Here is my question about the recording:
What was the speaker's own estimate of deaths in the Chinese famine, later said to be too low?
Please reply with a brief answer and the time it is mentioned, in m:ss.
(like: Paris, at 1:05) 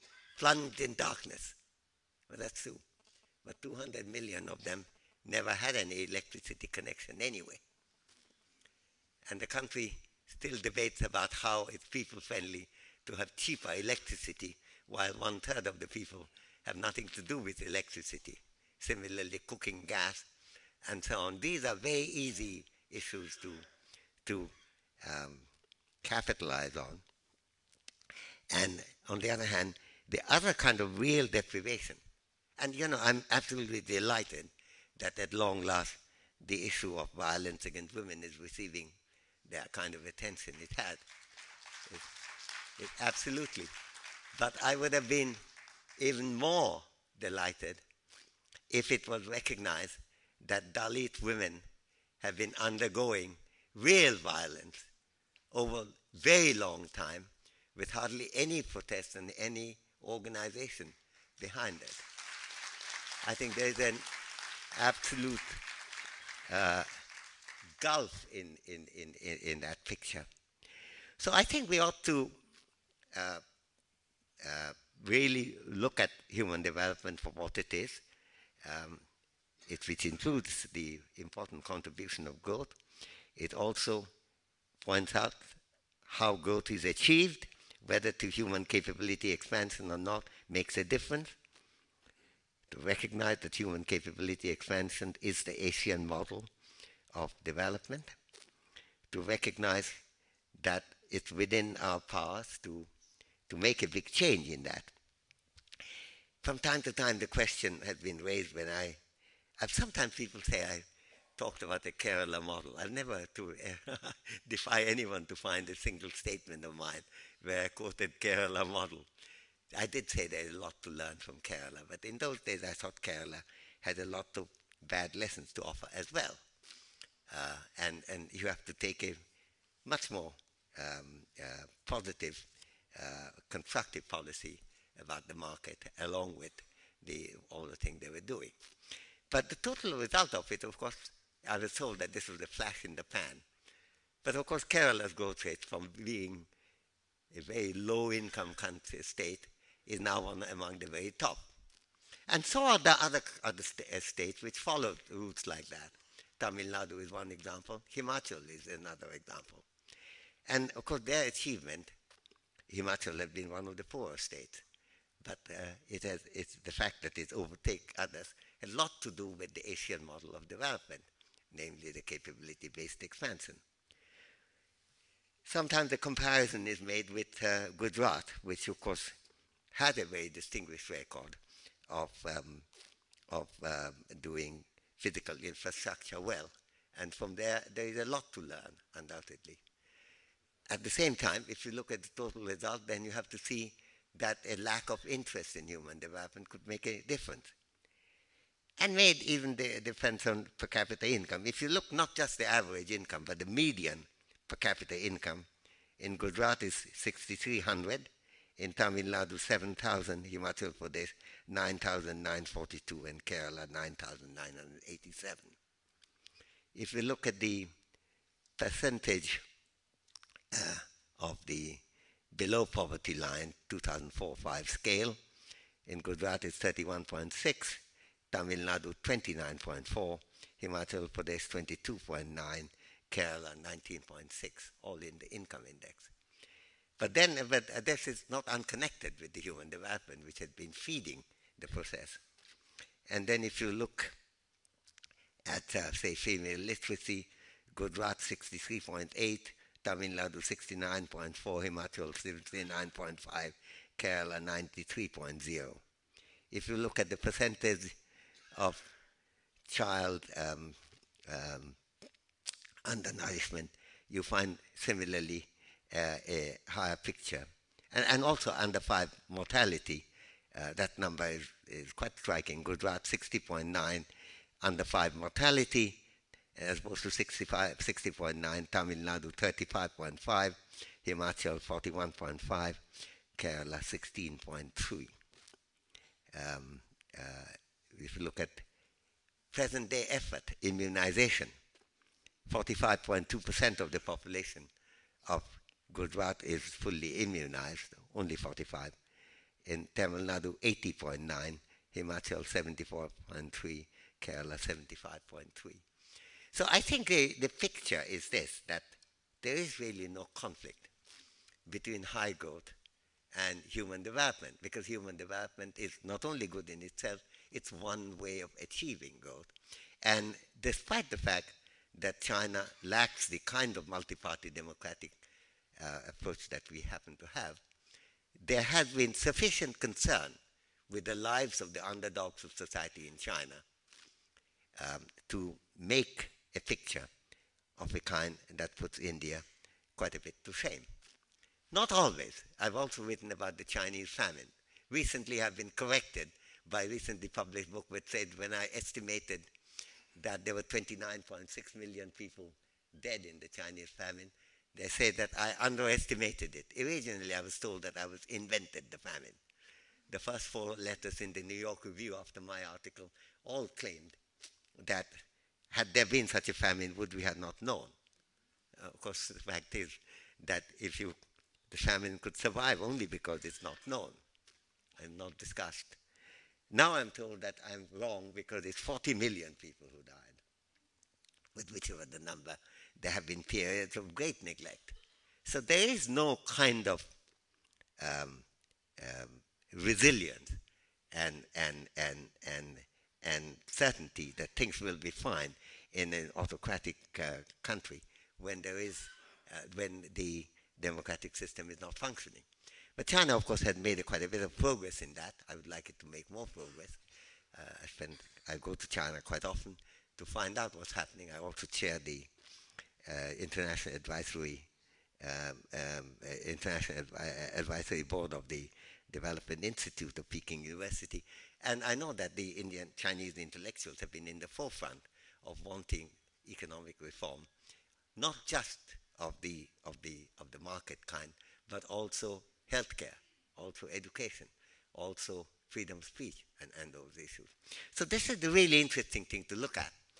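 29.6 million, at 5:50.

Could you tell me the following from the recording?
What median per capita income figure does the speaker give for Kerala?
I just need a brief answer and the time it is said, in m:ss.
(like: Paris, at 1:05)
9,987, at 3:33.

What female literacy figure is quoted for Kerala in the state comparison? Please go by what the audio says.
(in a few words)
93.0.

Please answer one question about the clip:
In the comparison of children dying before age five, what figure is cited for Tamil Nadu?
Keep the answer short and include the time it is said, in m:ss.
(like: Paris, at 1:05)
35.5, at 4:38.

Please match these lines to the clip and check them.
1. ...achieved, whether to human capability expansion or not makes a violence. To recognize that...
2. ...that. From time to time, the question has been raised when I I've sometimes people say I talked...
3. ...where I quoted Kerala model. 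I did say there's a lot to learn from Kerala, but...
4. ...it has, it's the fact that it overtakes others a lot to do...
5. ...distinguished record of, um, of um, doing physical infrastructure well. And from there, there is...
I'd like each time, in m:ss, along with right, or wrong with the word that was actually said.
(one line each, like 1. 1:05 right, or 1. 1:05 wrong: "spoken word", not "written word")
1. 1:26 wrong: "difference", not "violence"
2. 1:44 right
3. 1:57 right
4. 2:45 right
5. 3:00 right.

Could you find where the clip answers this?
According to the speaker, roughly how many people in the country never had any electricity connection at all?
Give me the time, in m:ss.
0:03.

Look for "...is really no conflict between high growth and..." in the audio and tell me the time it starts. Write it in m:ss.
5:09.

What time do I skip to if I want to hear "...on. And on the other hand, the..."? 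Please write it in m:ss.
0:26.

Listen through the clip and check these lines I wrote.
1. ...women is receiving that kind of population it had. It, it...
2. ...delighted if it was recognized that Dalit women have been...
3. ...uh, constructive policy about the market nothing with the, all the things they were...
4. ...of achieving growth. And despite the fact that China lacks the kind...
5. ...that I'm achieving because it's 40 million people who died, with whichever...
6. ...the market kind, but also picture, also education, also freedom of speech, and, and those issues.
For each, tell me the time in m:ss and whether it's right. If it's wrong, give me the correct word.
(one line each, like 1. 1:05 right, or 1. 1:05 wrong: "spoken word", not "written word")
1. 0:37 wrong: "attention", not "population"
2. 0:47 right
3. 2:12 wrong: "along", not "nothing"
4. 5:18 right
5. 6:17 wrong: "wrong", not "achieving"
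6. 7:10 wrong: "healthcare", not "picture".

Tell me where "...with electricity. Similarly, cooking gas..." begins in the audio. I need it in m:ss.
0:17.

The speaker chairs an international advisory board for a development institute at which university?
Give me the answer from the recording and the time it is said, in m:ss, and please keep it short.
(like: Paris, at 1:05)
Peking University, at 7:00.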